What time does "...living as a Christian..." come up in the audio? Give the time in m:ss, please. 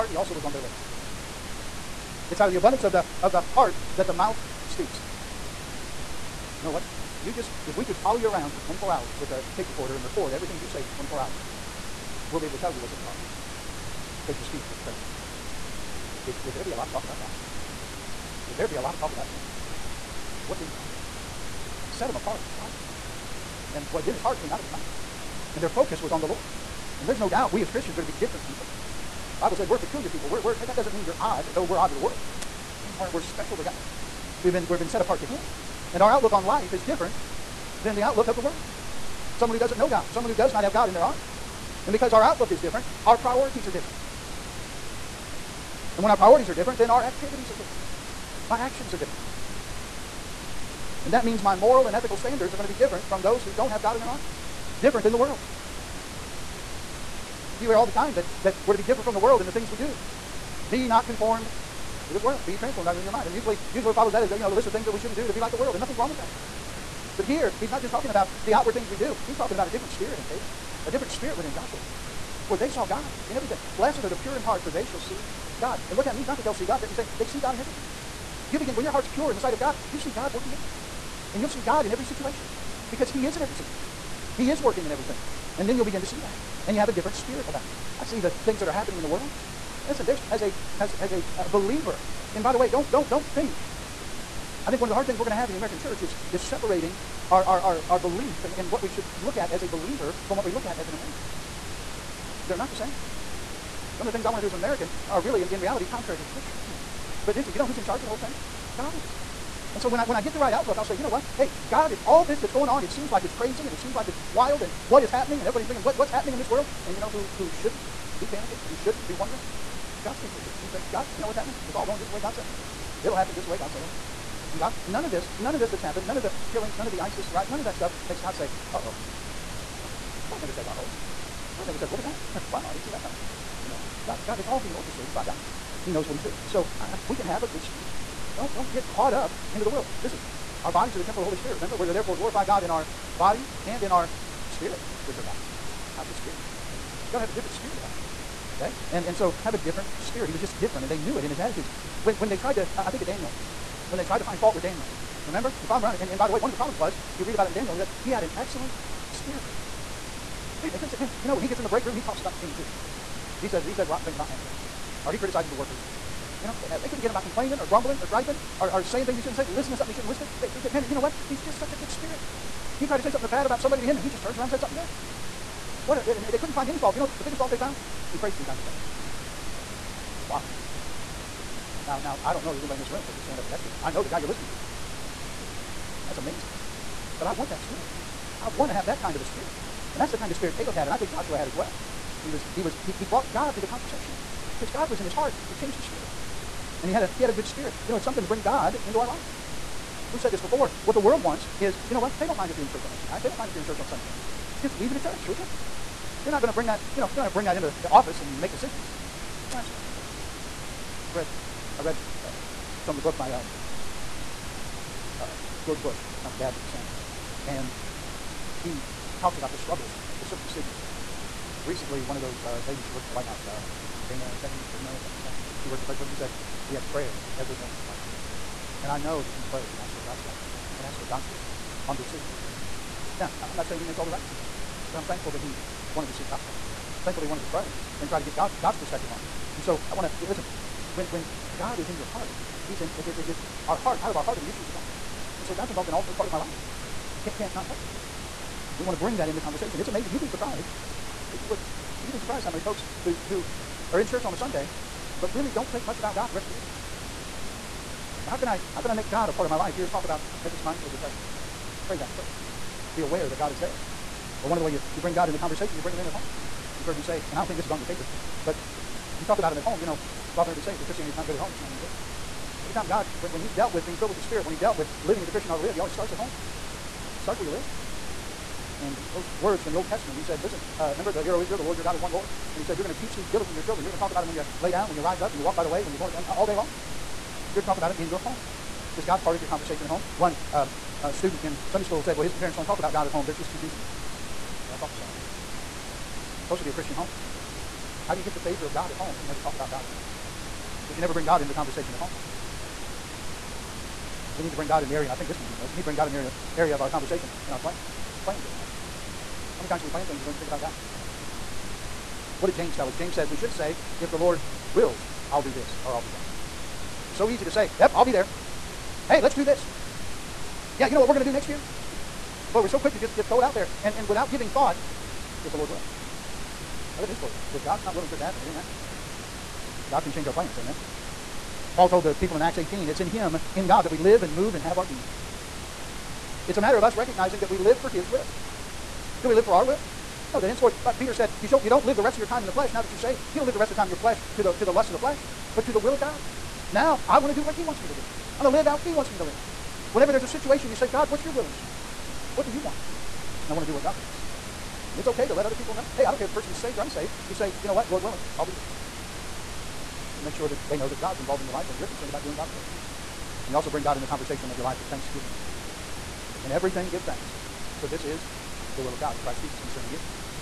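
4:35.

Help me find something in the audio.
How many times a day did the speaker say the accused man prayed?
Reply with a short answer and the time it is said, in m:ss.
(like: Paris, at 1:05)
3, at 2:58.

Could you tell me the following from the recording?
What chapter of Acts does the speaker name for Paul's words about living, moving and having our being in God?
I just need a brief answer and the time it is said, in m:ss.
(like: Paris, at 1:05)
18, at 5:32.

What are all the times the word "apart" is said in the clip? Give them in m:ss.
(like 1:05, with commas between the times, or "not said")
0:22, 0:35.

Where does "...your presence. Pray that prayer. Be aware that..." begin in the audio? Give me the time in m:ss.
4:20.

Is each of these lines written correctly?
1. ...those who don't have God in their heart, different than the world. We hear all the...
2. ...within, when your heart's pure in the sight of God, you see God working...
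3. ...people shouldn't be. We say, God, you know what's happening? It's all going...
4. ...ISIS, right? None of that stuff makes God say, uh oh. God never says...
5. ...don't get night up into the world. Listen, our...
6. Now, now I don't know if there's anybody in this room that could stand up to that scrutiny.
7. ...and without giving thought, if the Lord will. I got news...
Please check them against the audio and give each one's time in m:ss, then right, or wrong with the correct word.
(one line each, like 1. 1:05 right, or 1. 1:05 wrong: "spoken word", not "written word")
1. 0:53 right
2. 1:18 wrong: "begin", not "within"
3. 2:00 right
4. 2:06 right
5. 2:18 wrong: "caught", not "night"
6. 3:01 right
7. 5:23 right.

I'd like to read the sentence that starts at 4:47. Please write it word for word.
You're to talk about him in your home.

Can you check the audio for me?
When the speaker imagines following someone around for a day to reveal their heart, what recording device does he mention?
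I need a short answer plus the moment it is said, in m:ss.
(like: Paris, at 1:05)
tape recorder, at 0:09.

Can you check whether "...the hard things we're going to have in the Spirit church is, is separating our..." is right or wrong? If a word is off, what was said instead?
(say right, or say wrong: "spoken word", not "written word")
wrong: "American", not "Spirit".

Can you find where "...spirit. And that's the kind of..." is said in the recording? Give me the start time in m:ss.
3:09.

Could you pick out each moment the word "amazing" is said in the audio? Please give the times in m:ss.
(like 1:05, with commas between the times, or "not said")
3:06, 4:09.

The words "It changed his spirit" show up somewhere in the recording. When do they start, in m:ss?
3:15.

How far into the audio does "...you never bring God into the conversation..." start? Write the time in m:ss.
5:00.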